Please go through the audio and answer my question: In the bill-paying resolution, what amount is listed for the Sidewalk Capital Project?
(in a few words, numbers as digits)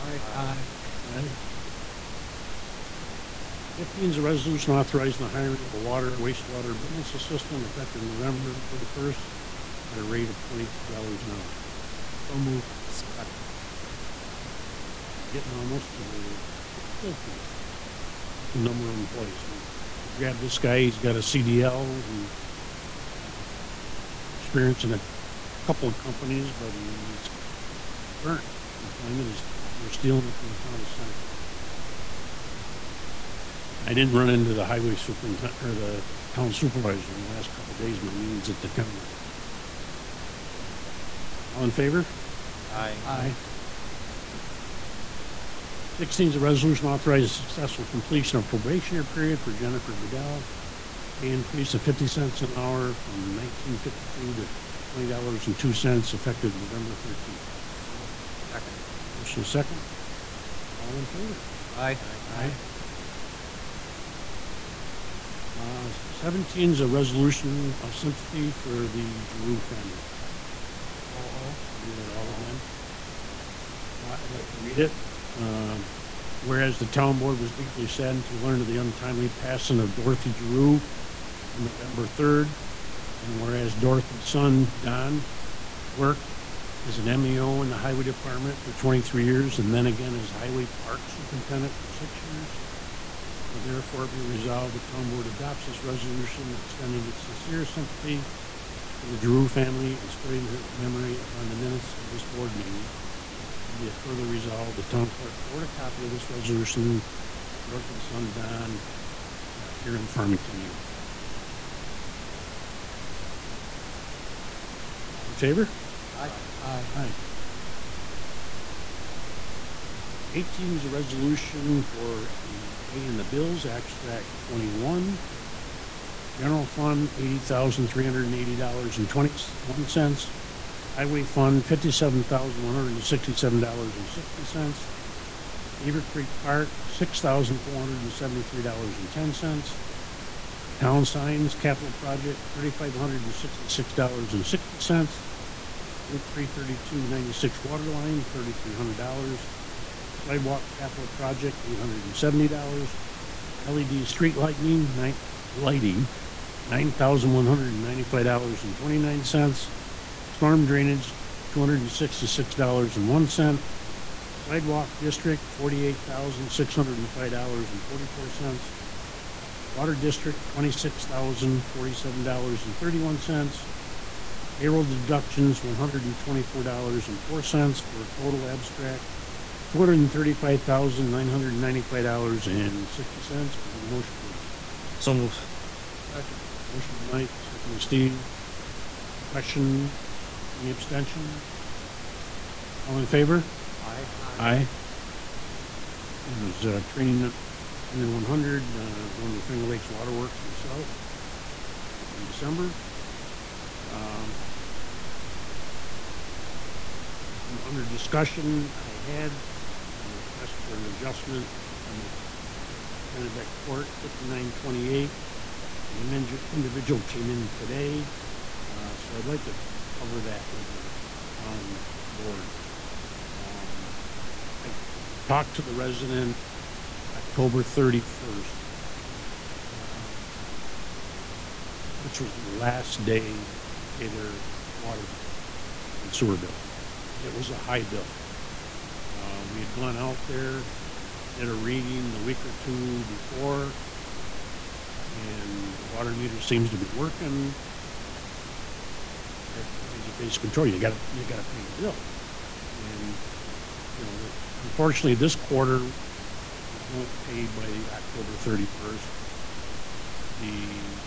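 $870.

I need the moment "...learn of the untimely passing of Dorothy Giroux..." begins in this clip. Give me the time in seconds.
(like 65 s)
78 s.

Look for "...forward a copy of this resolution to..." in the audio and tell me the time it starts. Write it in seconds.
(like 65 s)
105 s.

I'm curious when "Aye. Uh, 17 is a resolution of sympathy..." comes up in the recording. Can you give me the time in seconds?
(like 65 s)
62 s.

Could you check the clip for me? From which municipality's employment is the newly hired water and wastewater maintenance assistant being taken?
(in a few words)
Town of Seneca.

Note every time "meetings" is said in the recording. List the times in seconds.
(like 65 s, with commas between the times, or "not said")
38 s, 102 s.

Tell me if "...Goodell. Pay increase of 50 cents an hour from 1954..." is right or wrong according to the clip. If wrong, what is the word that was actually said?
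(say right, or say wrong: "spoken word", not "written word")
wrong: "1952", not "1954".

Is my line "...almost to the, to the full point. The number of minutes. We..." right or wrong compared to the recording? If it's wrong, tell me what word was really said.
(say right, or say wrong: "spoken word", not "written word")
wrong: "employees", not "minutes".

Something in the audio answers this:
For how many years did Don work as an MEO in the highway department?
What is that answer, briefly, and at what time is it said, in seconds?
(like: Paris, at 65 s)
23, at 88 s.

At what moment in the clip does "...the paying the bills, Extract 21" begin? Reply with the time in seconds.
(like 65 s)
122 s.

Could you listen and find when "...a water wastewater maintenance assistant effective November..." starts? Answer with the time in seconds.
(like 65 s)
5 s.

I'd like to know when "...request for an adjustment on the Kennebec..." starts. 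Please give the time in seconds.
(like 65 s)
210 s.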